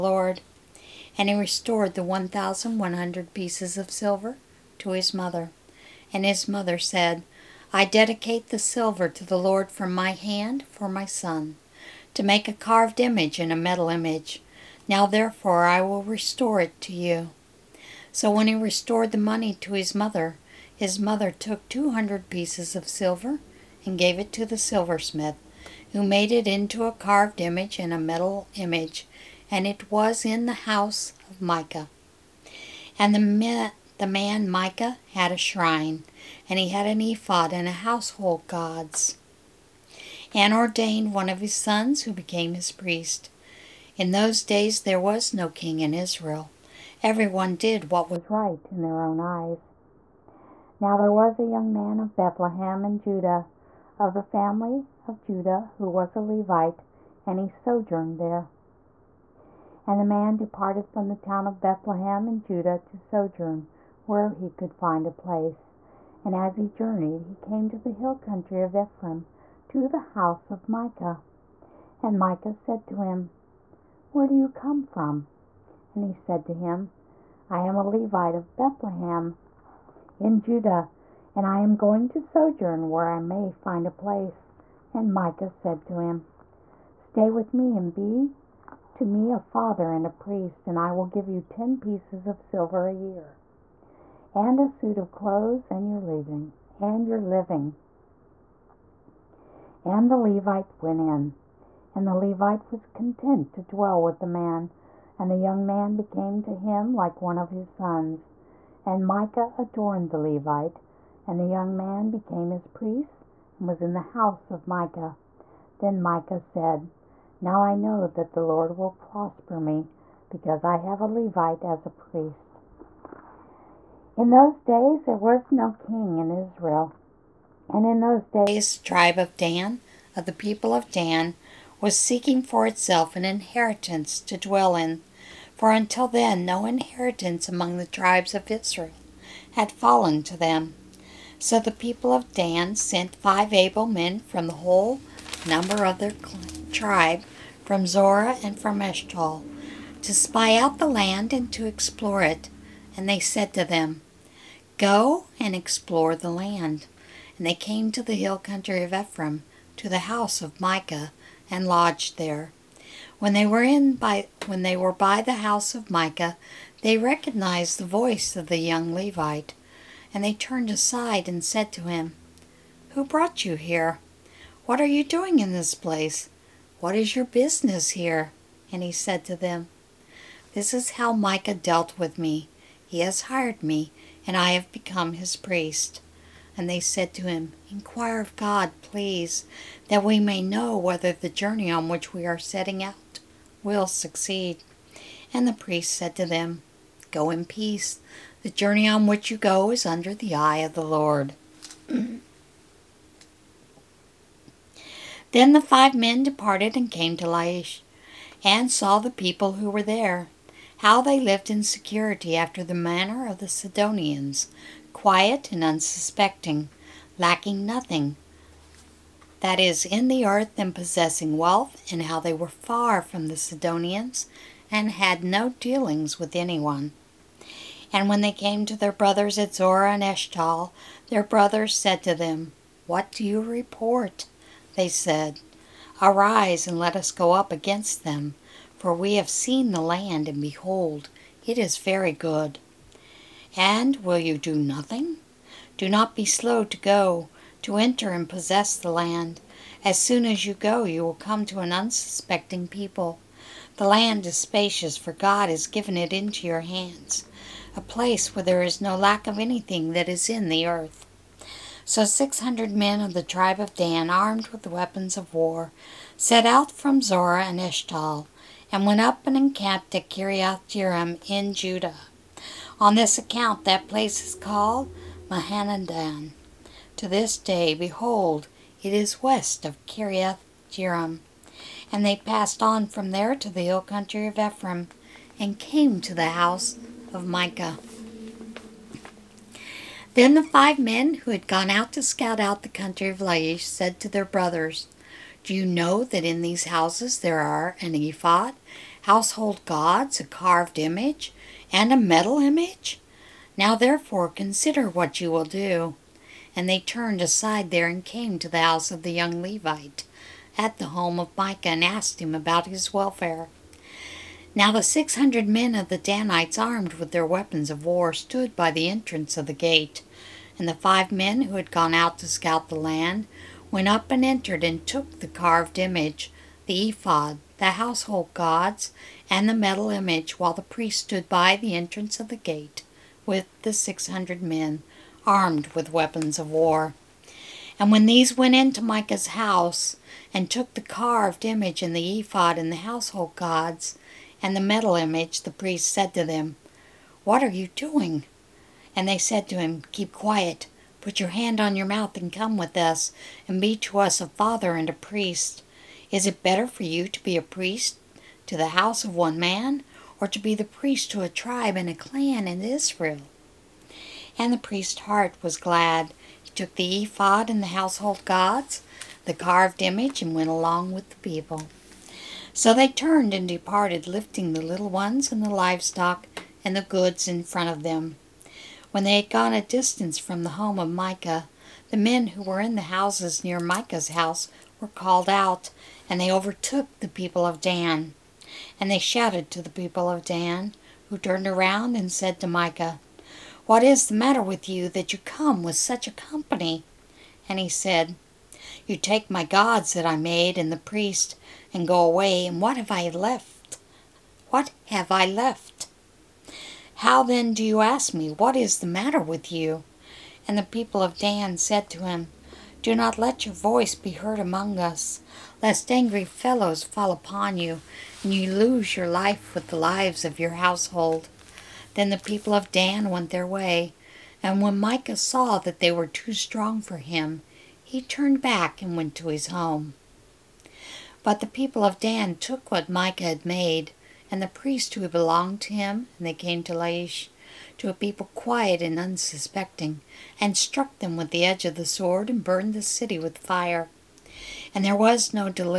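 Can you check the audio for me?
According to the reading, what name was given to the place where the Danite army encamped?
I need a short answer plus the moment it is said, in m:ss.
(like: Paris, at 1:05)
Mahanaim, at 4:35.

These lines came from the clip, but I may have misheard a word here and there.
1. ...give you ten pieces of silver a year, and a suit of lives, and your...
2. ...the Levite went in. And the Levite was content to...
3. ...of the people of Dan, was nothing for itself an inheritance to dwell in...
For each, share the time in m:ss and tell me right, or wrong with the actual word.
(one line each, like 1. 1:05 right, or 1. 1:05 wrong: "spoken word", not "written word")
1. 1:31 wrong: "clothes", not "lives"
2. 1:40 right
3. 2:10 wrong: "seeking", not "nothing".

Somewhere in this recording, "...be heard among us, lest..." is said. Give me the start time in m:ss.
6:53.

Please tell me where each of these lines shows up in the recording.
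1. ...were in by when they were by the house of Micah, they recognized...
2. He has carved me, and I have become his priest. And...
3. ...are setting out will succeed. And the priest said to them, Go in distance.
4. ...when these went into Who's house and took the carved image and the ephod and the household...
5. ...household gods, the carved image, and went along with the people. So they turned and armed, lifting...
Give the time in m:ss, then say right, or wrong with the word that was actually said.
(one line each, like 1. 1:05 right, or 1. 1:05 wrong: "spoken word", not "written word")
1. 2:43 right
2. 3:02 wrong: "hired", not "carved"
3. 3:12 wrong: "peace", not "distance"
4. 5:37 wrong: "Micah", not "Who"
5. 6:07 wrong: "departed", not "armed".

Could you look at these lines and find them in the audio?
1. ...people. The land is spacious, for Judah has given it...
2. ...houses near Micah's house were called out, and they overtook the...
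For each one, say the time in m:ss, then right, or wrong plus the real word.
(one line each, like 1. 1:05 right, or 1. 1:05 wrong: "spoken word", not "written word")
1. 4:12 wrong: "God", not "Judah"
2. 6:22 right.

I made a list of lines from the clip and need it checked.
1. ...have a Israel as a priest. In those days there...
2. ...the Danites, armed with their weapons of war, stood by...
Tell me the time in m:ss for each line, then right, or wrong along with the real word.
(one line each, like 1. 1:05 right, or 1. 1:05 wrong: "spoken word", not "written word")
1. 2:00 wrong: "Levite", not "Israel"
2. 5:15 right.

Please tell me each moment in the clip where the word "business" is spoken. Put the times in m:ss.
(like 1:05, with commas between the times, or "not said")
2:57.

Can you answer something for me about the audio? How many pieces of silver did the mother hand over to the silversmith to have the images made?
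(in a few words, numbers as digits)
200.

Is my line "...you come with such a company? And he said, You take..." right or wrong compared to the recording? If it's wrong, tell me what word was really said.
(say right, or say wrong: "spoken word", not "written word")
right.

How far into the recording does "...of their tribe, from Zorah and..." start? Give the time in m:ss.
2:25.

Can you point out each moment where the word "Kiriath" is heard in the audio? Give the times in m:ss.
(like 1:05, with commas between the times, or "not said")
4:30, 4:39.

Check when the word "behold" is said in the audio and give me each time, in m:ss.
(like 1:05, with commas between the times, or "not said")
4:00, 4:37.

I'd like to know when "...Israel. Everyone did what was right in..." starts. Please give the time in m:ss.
0:45.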